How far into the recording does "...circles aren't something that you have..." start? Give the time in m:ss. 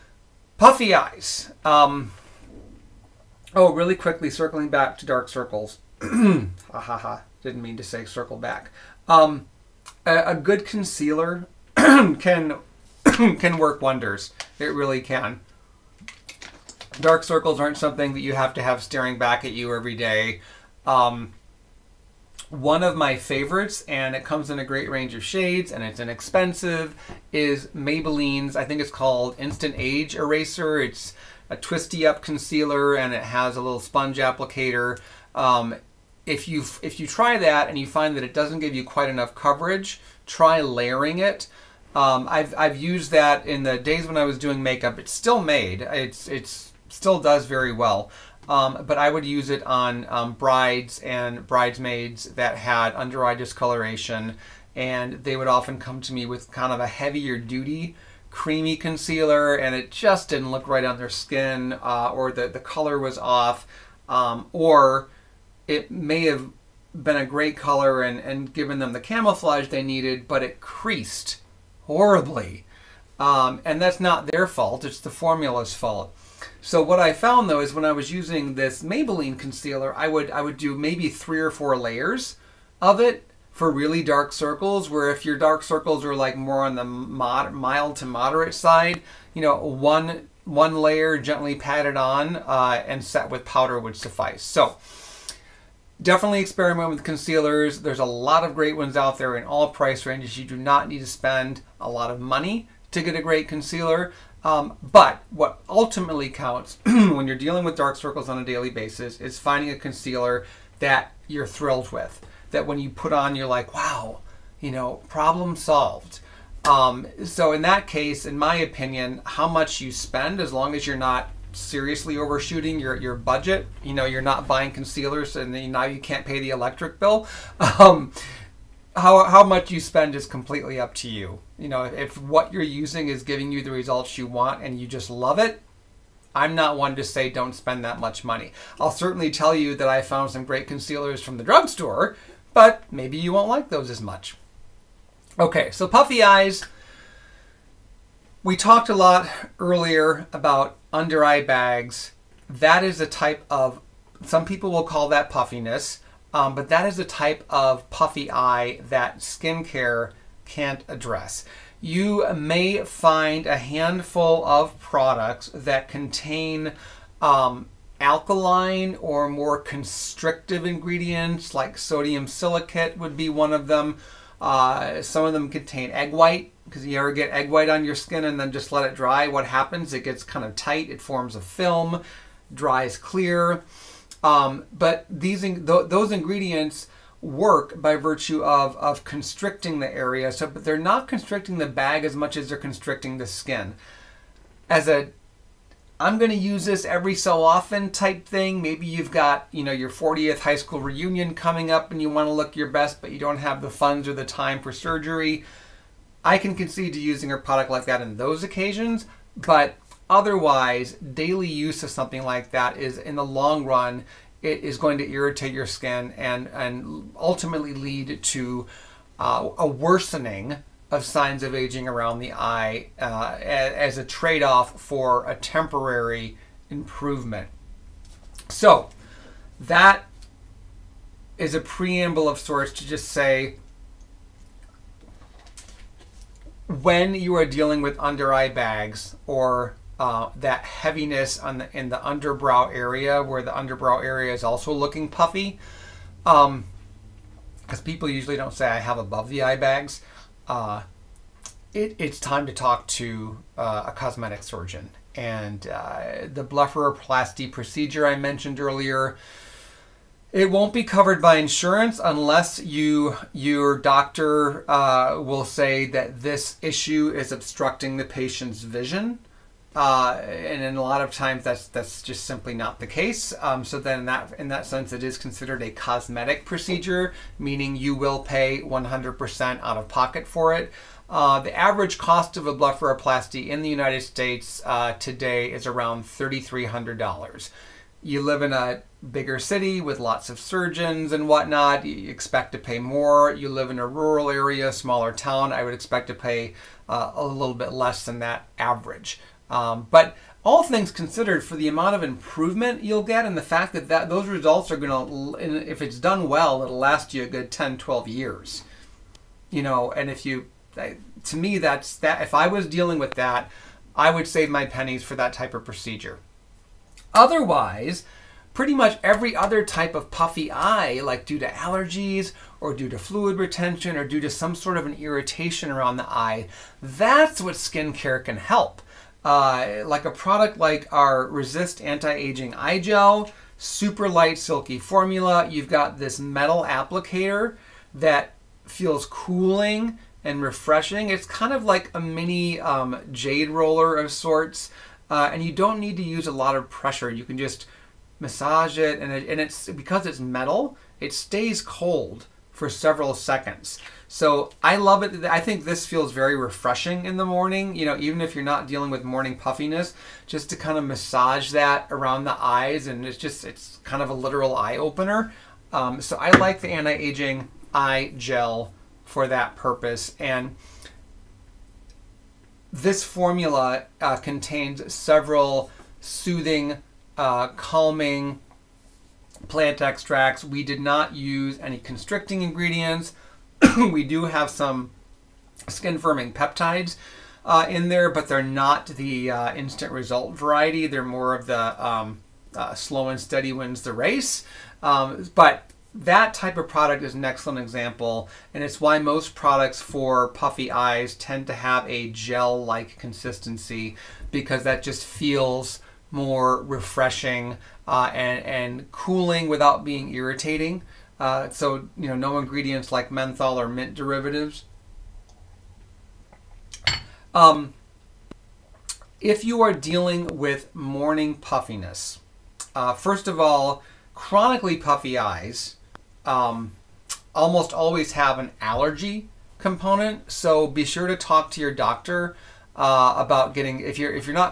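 0:17.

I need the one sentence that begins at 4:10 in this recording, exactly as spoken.
Uh, it, it's time to talk to uh, a cosmetic surgeon.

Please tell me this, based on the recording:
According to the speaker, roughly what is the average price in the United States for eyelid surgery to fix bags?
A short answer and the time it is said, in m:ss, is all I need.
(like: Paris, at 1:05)
$3,300, at 4:46.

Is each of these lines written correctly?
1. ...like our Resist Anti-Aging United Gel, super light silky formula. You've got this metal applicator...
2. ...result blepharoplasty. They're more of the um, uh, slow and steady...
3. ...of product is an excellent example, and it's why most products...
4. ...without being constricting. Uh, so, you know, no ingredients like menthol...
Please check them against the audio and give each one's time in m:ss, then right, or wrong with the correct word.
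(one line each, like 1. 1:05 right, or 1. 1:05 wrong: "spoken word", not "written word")
1. 5:30 wrong: "Eye", not "United"
2. 6:29 wrong: "variety", not "blepharoplasty"
3. 6:36 right
4. 6:49 wrong: "irritating", not "constricting".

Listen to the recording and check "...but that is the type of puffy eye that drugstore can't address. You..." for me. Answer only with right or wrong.
wrong.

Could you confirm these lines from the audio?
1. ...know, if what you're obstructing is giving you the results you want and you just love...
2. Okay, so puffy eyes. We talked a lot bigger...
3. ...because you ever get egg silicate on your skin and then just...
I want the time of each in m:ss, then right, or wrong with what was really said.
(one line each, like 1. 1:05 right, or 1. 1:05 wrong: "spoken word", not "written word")
1. 2:11 wrong: "using", not "obstructing"
2. 2:25 wrong: "earlier", not "bigger"
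3. 2:56 wrong: "white", not "silicate".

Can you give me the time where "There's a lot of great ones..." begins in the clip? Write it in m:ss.
1:37.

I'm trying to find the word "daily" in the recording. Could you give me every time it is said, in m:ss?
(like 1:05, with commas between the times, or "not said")
1:48, 3:30.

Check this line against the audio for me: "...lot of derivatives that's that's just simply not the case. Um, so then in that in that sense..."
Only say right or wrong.
wrong.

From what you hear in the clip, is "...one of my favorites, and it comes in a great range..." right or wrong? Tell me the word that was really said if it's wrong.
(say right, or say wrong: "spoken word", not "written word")
right.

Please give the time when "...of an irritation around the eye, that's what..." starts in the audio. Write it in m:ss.
5:24.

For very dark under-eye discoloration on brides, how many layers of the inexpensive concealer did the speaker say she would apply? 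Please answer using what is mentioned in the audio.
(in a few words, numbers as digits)
3 or 4.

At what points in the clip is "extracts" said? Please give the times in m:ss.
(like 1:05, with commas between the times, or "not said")
6:19.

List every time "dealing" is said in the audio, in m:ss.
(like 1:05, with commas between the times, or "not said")
1:47, 3:57, 5:12, 5:58, 6:59.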